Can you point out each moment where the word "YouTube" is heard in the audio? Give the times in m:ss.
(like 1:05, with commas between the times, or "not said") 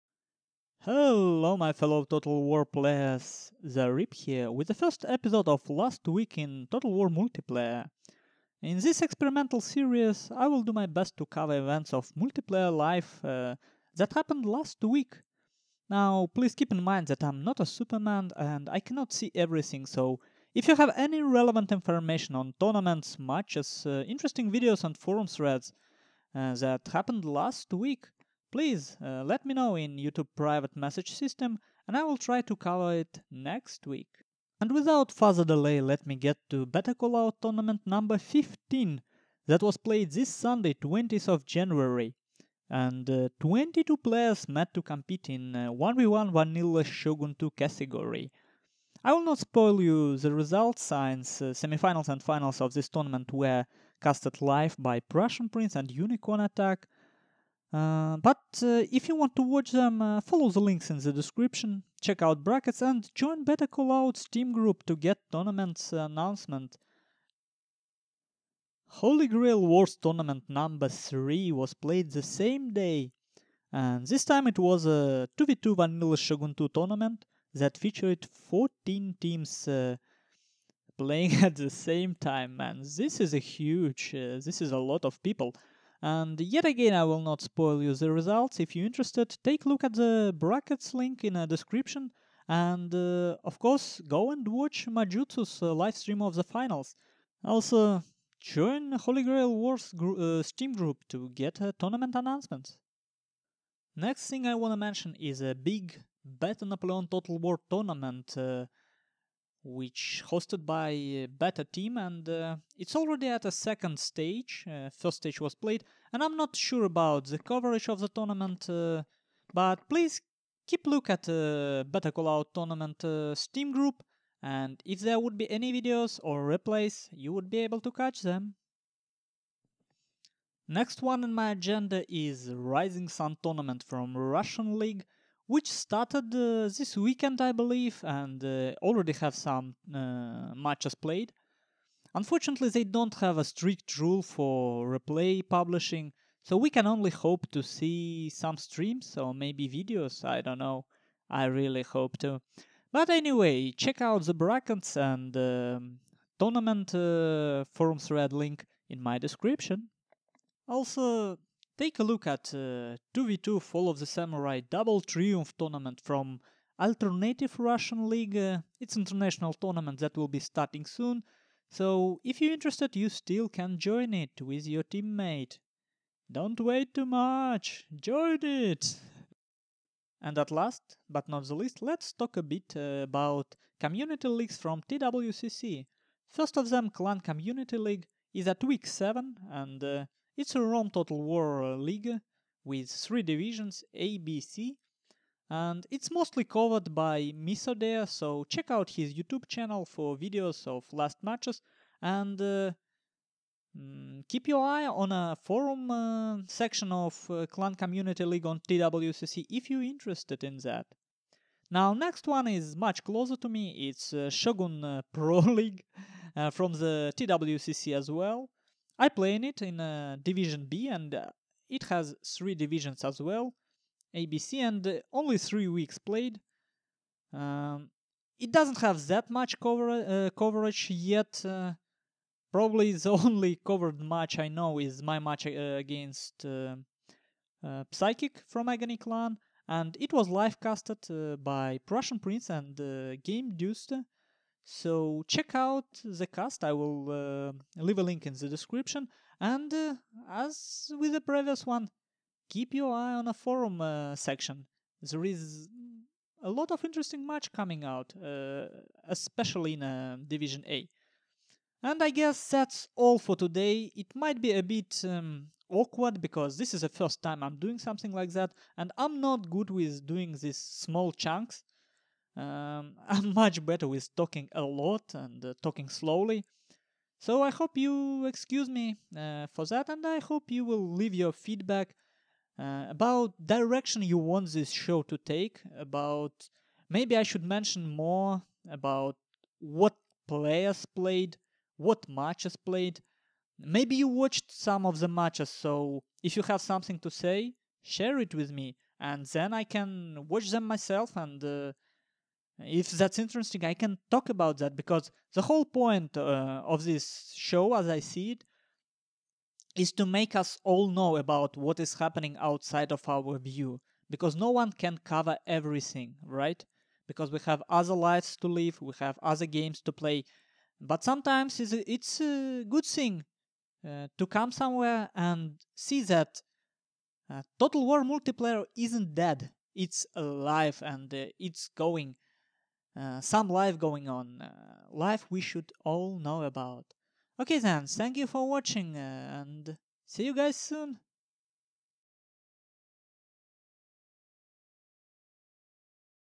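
0:29, 3:19.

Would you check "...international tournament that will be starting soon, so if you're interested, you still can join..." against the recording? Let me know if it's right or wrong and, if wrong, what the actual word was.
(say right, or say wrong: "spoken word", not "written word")
right.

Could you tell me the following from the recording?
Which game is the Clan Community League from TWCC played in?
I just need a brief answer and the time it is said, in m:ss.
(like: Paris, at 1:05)
Rome Total War, at 3:10.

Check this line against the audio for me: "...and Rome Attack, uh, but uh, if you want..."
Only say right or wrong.
wrong.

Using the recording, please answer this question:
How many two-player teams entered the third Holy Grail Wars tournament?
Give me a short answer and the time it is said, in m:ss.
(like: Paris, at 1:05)
14, at 1:18.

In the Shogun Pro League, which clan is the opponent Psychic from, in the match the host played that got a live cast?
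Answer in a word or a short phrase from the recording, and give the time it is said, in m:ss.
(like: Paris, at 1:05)
Agony, at 3:58.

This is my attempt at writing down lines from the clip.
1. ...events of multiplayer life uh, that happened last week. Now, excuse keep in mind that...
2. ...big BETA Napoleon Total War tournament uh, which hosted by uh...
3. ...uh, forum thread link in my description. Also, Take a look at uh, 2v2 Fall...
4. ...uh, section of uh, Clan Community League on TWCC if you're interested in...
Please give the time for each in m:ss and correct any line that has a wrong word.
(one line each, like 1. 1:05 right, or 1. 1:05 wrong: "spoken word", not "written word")
1. 0:11 wrong: "please", not "excuse"
2. 1:45 right
3. 2:36 right
4. 3:25 right.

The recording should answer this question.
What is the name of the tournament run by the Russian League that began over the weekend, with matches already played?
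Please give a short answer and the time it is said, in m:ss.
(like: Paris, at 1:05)
Rising Sun, at 2:12.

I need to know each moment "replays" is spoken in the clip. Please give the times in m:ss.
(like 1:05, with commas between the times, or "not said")
2:06, 2:24.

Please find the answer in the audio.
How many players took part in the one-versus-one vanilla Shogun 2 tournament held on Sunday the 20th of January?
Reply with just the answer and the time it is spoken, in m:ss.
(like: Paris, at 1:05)
22, at 0:43.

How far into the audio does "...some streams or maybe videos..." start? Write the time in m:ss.
2:28.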